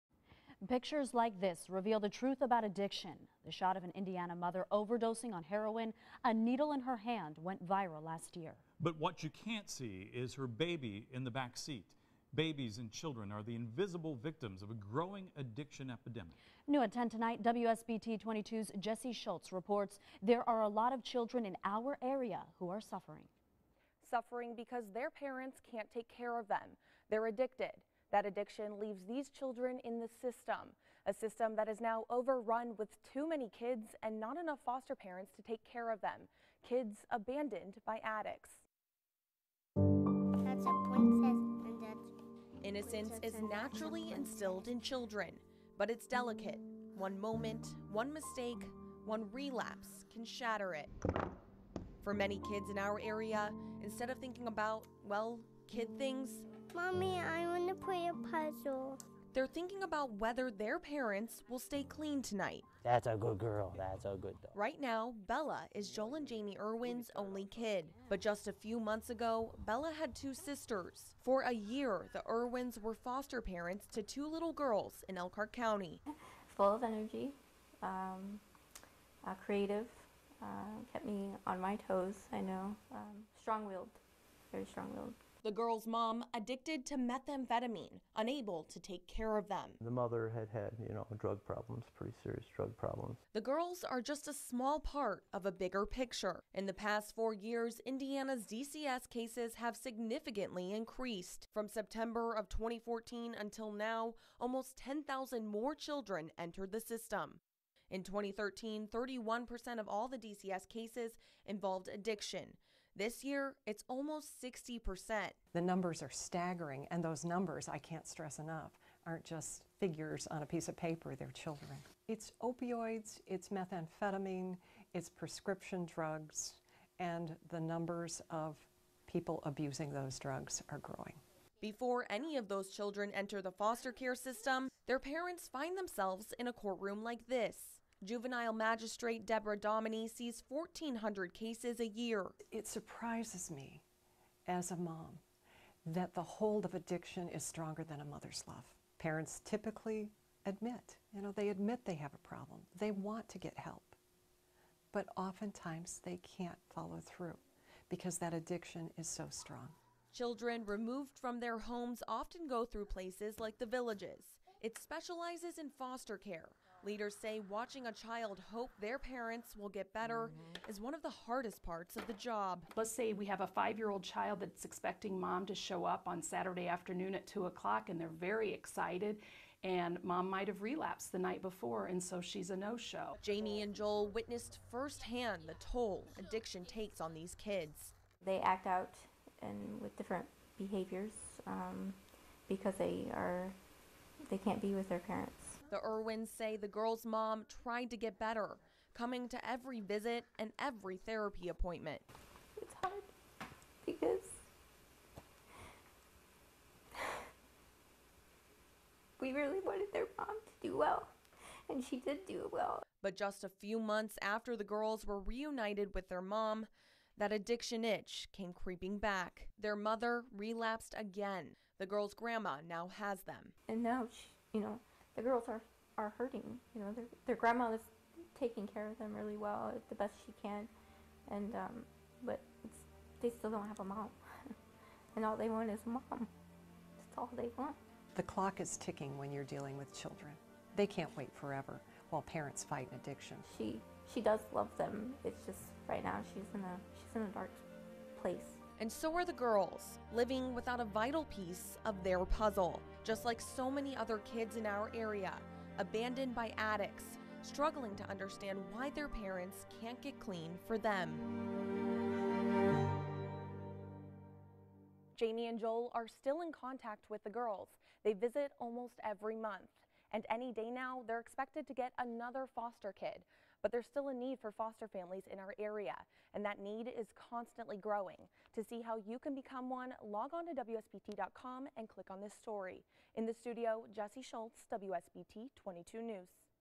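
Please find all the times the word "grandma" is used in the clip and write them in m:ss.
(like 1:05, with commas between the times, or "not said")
3:42, 3:47.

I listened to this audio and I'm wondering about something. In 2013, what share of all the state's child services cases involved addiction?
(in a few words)
31%.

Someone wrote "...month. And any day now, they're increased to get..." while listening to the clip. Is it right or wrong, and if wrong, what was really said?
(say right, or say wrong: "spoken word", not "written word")
wrong: "expected", not "increased".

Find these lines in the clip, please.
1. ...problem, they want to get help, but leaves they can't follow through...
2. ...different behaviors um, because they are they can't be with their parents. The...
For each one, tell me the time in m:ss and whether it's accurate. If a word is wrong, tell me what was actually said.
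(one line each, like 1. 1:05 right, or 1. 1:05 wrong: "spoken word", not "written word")
1. 2:32 wrong: "oftentimes", not "leaves"
2. 3:09 right.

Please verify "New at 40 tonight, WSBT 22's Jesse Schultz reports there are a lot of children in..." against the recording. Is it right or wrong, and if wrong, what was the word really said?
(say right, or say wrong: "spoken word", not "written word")
wrong: "10", not "40".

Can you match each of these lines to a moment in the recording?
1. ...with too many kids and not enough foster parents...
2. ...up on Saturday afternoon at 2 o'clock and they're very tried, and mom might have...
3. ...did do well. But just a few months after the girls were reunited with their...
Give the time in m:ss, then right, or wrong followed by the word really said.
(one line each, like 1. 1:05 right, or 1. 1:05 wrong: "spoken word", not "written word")
1. 0:32 right
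2. 2:55 wrong: "excited", not "tried"
3. 3:32 right.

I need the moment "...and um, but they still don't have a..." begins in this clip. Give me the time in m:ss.
3:51.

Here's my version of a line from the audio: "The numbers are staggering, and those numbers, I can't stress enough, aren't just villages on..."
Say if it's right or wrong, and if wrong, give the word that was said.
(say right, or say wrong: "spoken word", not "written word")
wrong: "figures", not "villages".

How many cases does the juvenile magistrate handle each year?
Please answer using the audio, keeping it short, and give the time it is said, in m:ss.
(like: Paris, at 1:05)
1,400, at 2:20.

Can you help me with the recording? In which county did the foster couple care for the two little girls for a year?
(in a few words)
Elkhart County.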